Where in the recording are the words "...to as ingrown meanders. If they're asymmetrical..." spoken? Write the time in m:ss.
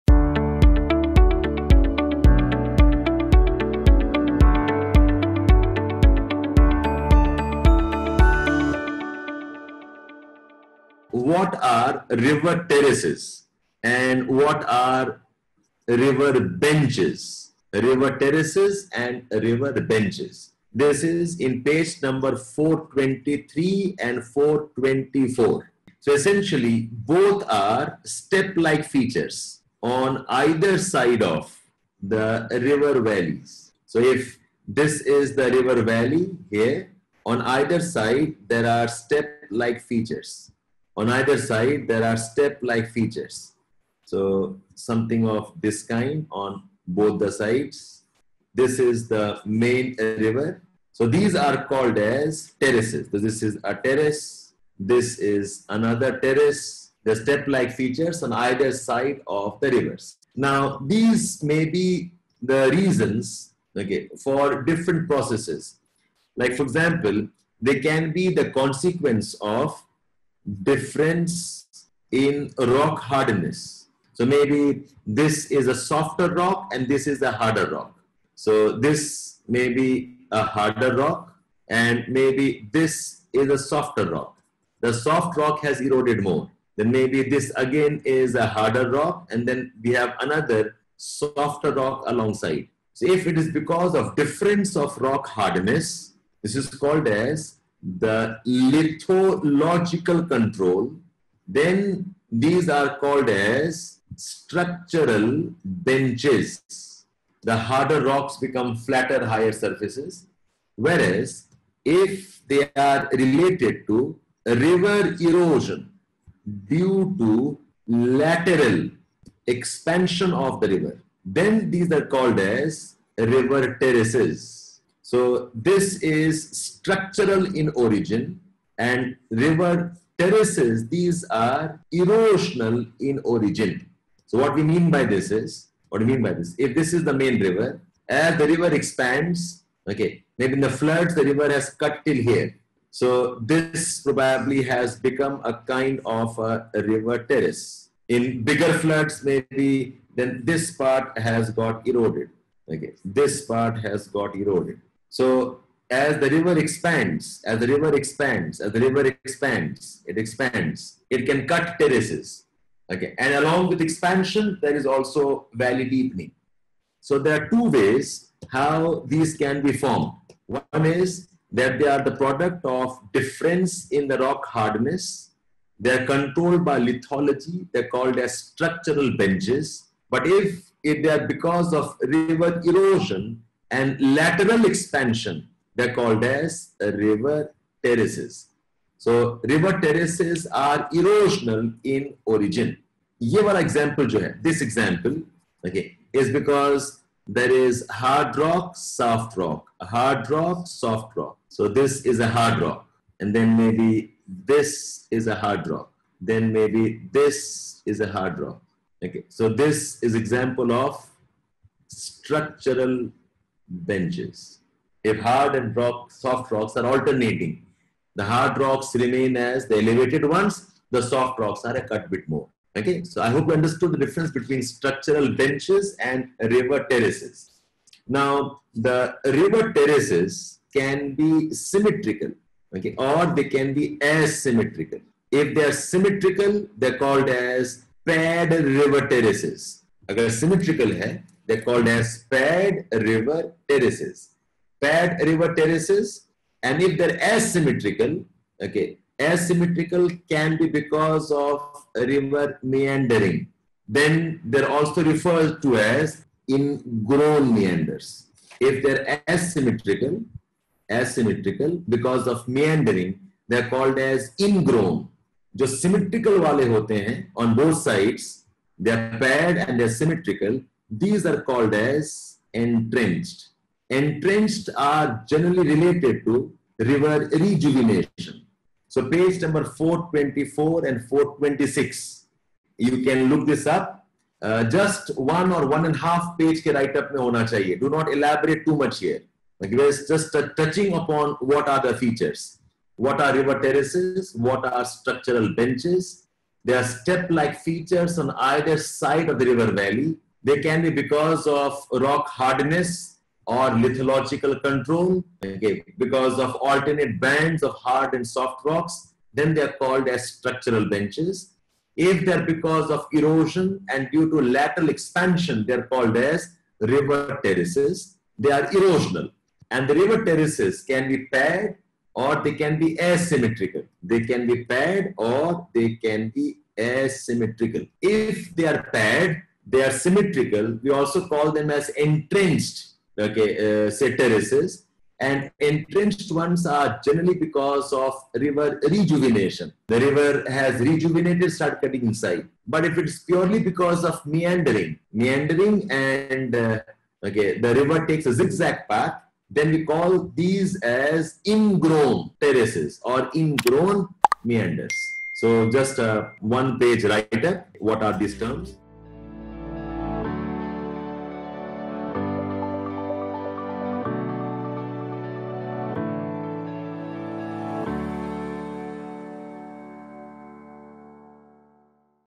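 4:15.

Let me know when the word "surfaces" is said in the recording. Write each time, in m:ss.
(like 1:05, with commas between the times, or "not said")
1:49.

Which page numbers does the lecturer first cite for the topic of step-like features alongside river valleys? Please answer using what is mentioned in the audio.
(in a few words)
423 and 424.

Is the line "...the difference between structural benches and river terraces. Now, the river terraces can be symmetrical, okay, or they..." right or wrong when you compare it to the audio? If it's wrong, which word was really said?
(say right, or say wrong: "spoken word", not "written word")
right.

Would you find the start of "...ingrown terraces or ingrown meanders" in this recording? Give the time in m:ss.
5:51.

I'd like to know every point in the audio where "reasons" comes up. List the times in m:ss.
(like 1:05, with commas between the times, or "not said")
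1:02.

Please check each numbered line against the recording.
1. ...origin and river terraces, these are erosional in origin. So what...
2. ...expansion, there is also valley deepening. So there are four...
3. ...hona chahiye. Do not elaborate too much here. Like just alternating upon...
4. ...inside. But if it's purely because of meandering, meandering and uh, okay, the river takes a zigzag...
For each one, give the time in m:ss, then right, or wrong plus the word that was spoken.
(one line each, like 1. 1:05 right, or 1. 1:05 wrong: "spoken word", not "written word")
1. 2:07 right
2. 2:43 wrong: "two", not "four"
3. 4:47 wrong: "touching", not "alternating"
4. 5:42 right.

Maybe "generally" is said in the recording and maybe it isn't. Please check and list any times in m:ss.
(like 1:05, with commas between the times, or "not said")
4:35, 5:37.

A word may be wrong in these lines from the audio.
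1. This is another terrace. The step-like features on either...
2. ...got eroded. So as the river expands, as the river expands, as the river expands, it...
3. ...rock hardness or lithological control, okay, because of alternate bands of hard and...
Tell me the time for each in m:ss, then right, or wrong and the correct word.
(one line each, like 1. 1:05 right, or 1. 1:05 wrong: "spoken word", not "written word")
1. 0:54 right
2. 2:34 right
3. 5:01 right.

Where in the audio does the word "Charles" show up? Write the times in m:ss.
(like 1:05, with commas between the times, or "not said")
not said.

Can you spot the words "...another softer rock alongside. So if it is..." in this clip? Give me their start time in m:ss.
1:30.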